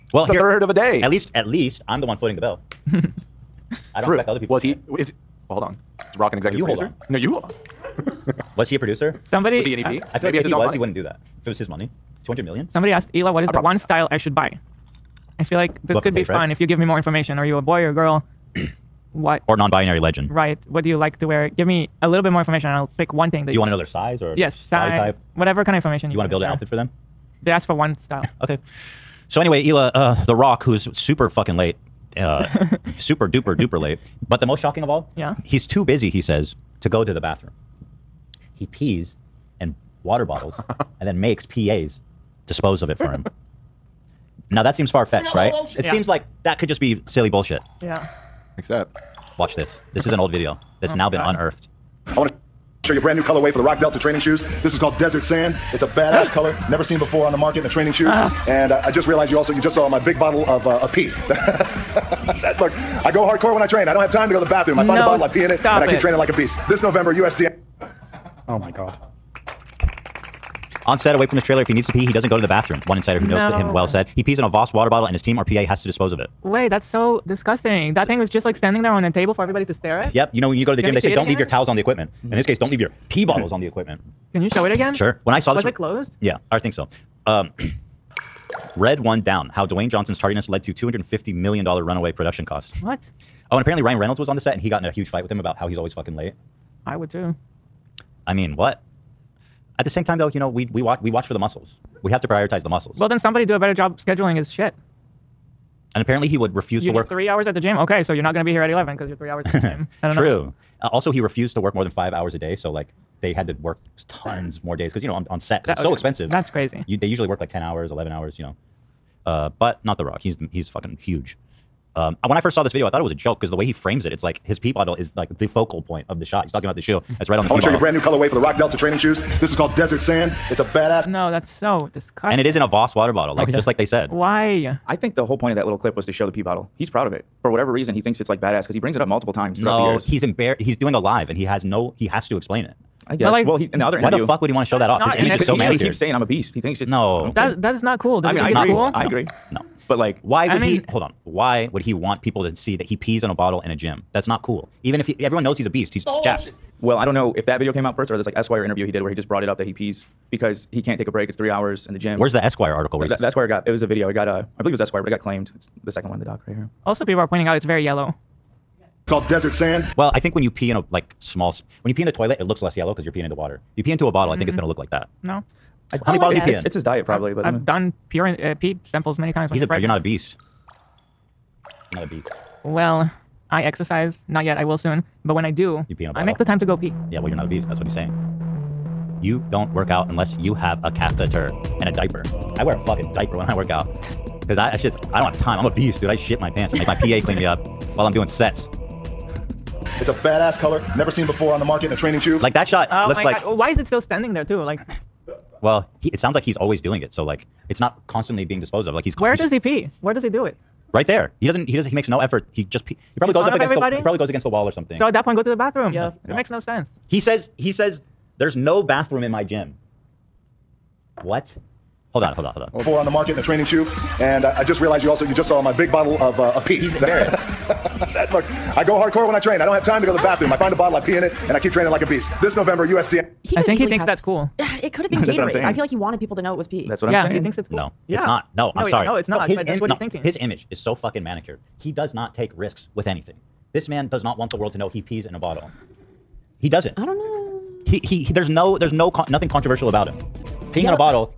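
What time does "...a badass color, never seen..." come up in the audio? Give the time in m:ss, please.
3:20.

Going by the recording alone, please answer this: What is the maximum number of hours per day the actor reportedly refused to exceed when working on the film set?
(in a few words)
5.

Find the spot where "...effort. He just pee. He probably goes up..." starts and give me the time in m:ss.
3:32.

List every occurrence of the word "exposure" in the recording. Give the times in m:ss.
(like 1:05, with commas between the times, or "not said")
not said.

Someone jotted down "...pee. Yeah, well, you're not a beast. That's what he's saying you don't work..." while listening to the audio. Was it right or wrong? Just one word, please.
right.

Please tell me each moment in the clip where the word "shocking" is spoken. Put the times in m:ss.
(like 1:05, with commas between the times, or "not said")
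0:34.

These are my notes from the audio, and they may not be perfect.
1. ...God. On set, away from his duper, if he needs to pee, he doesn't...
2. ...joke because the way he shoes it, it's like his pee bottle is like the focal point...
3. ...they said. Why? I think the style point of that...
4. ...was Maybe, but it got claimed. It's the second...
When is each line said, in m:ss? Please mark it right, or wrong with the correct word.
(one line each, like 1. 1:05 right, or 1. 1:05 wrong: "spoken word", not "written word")
1. 1:08 wrong: "trailer", not "duper"
2. 2:03 wrong: "frames", not "shoes"
3. 2:13 wrong: "whole", not "style"
4. 2:44 wrong: "Esquire", not "Maybe".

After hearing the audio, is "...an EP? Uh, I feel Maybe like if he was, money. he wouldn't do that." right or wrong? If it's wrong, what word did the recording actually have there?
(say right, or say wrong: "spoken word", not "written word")
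right.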